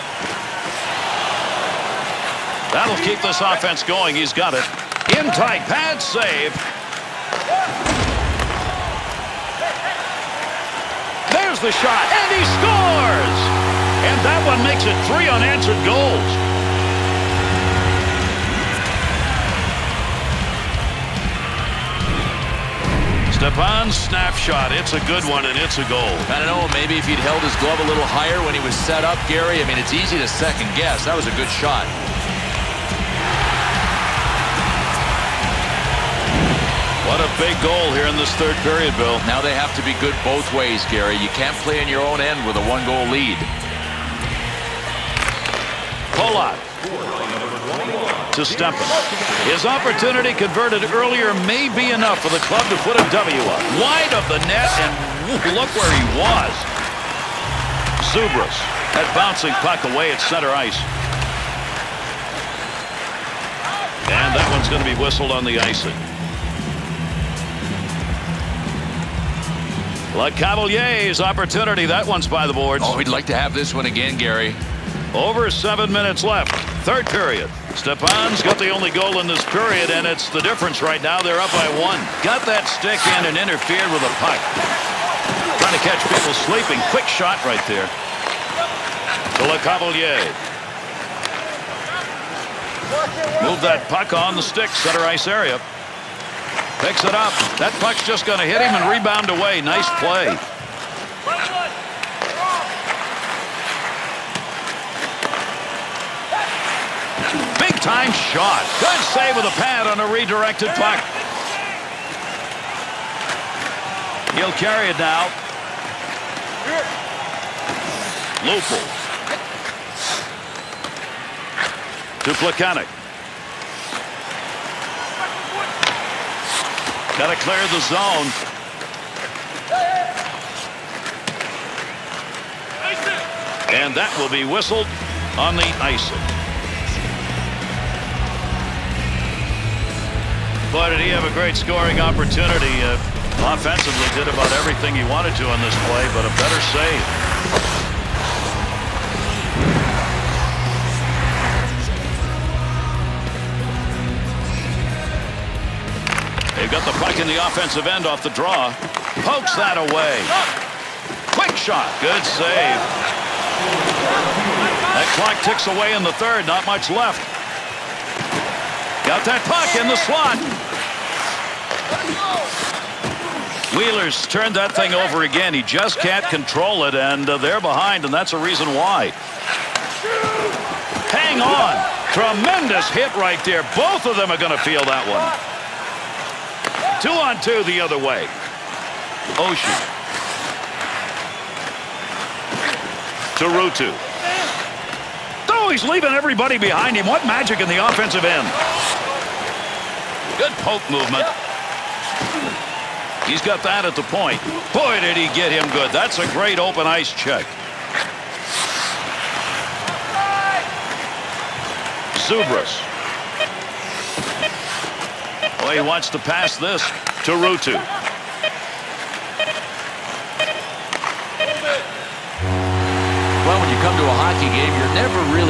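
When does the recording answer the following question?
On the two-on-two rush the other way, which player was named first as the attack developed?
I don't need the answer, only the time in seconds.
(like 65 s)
189 s.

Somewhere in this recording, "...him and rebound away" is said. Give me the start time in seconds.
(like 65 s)
98 s.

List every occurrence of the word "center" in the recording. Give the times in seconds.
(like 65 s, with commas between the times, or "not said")
60 s, 94 s.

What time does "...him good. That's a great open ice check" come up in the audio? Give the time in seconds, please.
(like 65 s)
205 s.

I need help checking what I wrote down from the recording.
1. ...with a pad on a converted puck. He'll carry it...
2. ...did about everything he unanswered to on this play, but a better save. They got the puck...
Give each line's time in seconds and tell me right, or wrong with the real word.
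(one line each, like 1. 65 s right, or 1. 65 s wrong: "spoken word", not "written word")
1. 109 s wrong: "redirected", not "converted"
2. 144 s wrong: "wanted", not "unanswered".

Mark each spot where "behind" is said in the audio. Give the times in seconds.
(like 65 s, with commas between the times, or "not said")
177 s, 196 s.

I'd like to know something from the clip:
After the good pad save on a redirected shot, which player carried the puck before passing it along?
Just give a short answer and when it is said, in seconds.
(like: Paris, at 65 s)
Lupul, at 118 s.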